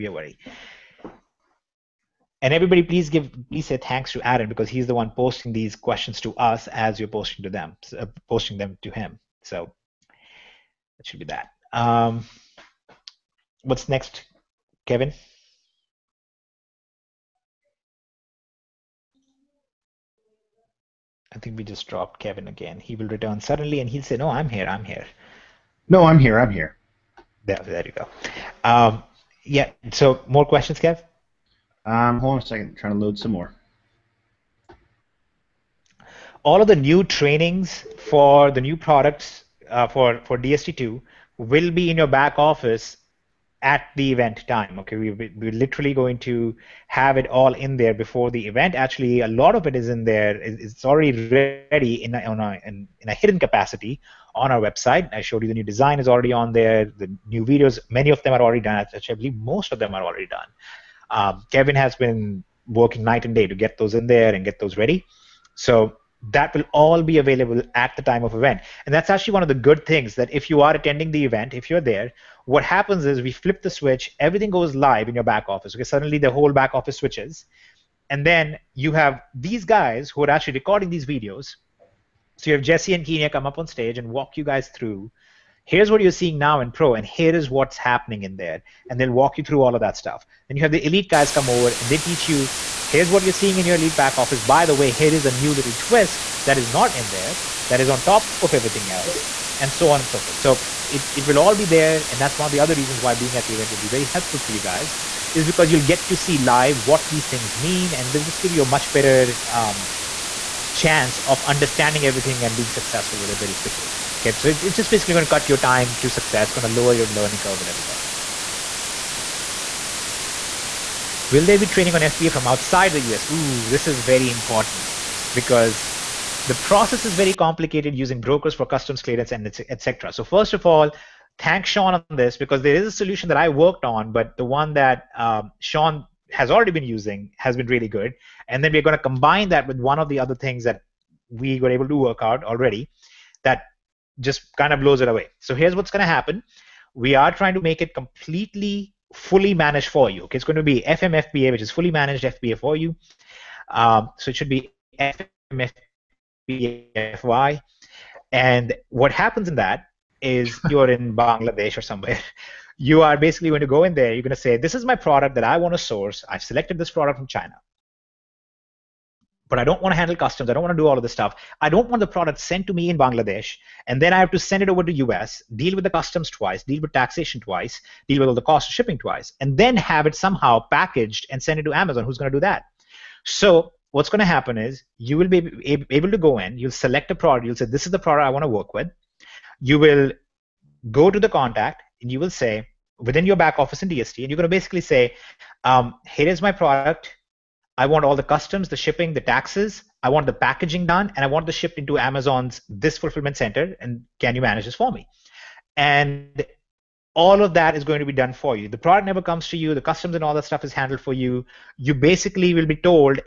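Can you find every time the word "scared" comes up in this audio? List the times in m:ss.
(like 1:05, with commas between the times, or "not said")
not said.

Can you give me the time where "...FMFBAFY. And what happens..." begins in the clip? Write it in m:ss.
2:36.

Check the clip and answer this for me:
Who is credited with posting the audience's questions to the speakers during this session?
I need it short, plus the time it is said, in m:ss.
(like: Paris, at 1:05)
Aaron, at 0:04.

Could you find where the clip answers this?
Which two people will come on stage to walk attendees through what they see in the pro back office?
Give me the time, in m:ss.
1:22.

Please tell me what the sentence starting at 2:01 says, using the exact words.
Will there be training on FBA from outside the US?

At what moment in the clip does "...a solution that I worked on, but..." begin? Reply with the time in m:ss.
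2:12.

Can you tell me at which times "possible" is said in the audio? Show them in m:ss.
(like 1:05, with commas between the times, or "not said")
not said.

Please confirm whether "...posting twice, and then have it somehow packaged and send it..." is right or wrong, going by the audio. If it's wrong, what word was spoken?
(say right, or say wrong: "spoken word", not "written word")
wrong: "shipping", not "posting".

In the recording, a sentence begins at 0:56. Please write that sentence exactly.
The new videos, many of them are already done.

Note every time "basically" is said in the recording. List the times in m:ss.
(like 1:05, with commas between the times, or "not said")
1:54, 2:43, 3:14, 3:31.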